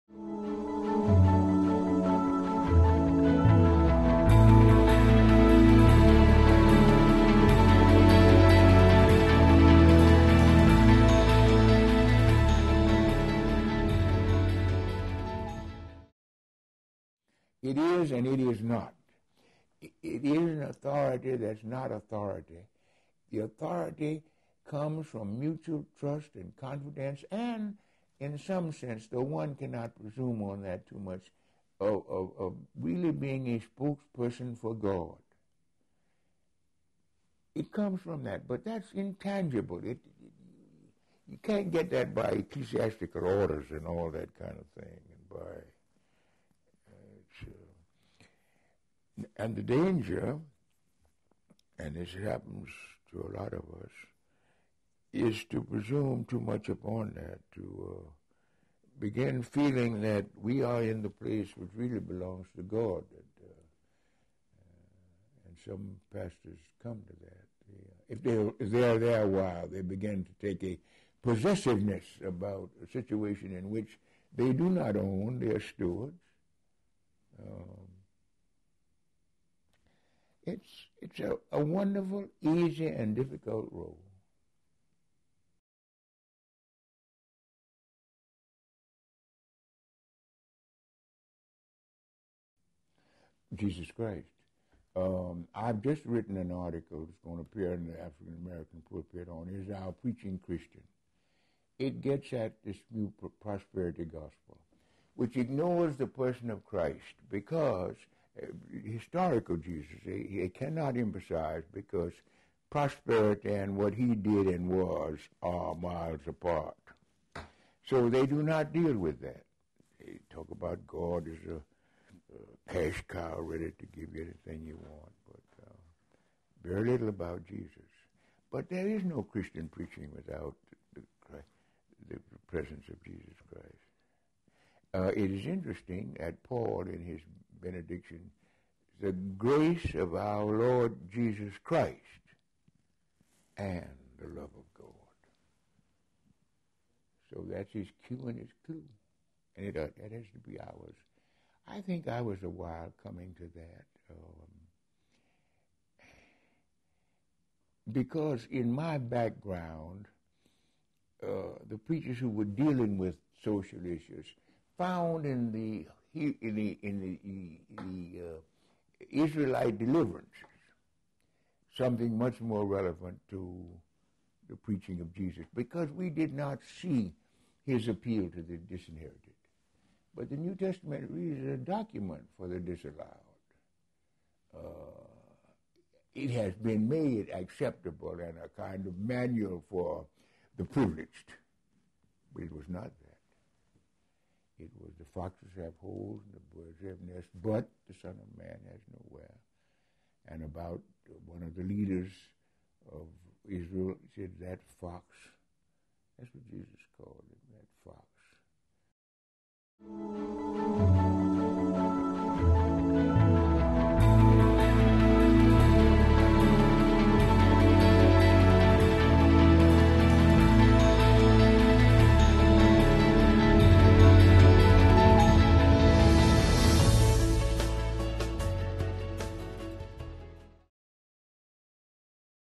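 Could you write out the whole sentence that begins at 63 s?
uh, uh, and some pastors come to that.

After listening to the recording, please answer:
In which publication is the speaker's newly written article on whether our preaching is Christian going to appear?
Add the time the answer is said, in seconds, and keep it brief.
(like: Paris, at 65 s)
The African American Pulpit, at 97 s.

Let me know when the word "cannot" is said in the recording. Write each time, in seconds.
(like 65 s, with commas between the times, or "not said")
29 s, 110 s.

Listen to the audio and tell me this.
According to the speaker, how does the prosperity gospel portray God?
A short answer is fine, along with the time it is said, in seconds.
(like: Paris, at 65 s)
A cash cow, at 122 s.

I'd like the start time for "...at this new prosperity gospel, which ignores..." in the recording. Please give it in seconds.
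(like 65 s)
102 s.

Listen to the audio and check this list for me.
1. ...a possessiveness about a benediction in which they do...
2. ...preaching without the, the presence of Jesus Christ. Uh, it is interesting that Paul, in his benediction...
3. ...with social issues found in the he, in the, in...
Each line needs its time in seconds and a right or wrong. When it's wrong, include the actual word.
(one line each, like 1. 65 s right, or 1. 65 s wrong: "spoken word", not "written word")
1. 70 s wrong: "situation", not "benediction"
2. 129 s right
3. 162 s right.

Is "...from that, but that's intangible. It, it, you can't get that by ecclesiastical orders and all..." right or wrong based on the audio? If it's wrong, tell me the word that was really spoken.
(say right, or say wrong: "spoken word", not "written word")
right.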